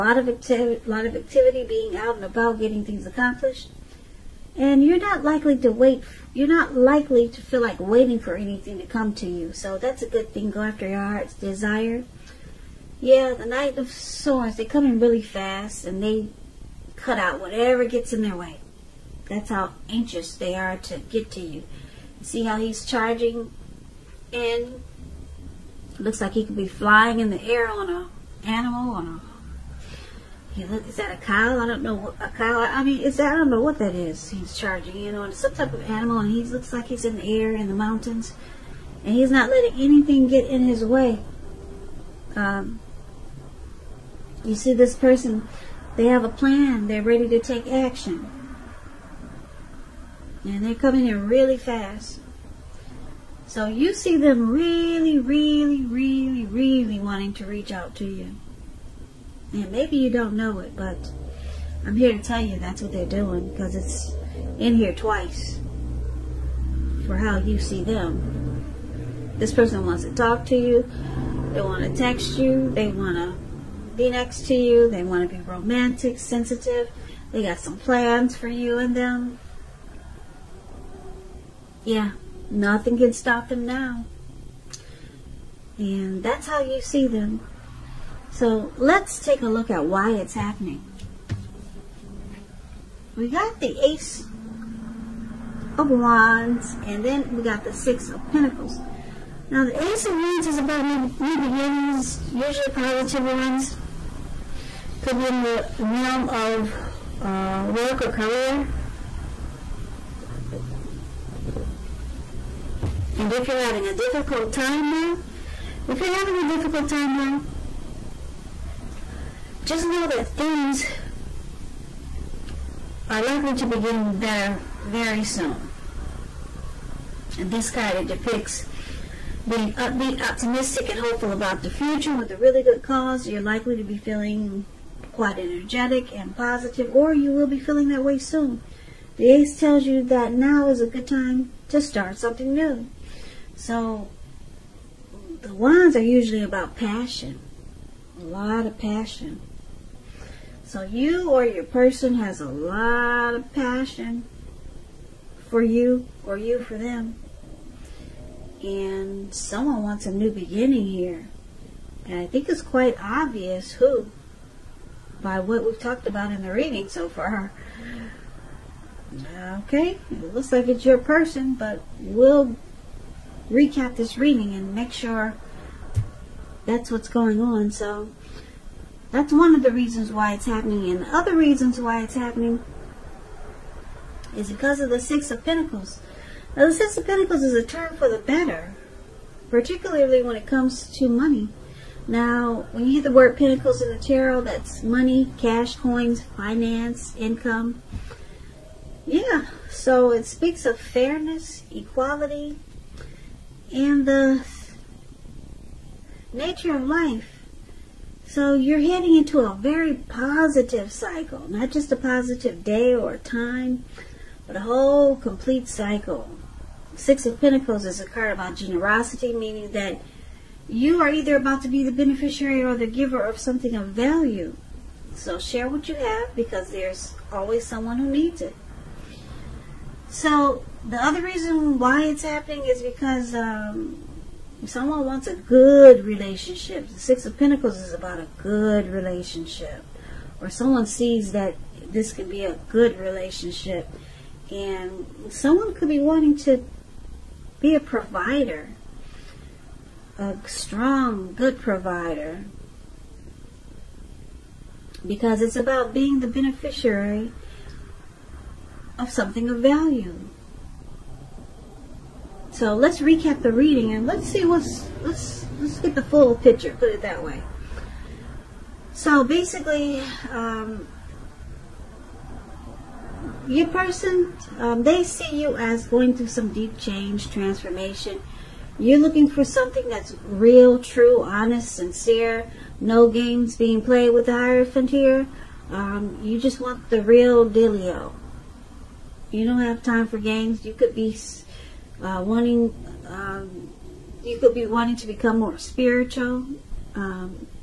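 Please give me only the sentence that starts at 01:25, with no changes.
And that's how you see them.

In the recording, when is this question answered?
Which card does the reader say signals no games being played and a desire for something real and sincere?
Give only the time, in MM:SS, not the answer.
04:44.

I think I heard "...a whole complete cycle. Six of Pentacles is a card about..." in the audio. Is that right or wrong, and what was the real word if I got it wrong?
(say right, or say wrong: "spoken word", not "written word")
right.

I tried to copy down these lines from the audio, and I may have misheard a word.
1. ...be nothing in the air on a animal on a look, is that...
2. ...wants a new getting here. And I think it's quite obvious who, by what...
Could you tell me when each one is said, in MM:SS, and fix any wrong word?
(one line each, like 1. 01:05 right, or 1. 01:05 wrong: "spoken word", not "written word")
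1. 00:26 wrong: "flying", not "nothing"
2. 02:39 wrong: "beginning", not "getting".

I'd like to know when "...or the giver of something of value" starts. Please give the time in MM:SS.
03:42.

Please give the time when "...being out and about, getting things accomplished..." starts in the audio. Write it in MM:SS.
00:01.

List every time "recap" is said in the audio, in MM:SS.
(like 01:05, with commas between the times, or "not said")
02:53, 04:23.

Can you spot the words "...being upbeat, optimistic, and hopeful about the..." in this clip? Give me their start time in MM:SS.
02:09.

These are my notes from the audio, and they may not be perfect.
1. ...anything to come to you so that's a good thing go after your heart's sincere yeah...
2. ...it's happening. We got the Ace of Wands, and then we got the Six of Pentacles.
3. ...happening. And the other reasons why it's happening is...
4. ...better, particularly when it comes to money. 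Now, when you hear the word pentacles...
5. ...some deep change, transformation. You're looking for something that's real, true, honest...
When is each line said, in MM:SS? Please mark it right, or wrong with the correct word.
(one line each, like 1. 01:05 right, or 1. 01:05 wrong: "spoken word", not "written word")
1. 00:08 wrong: "desire", not "sincere"
2. 01:30 right
3. 03:00 right
4. 03:08 right
5. 04:36 right.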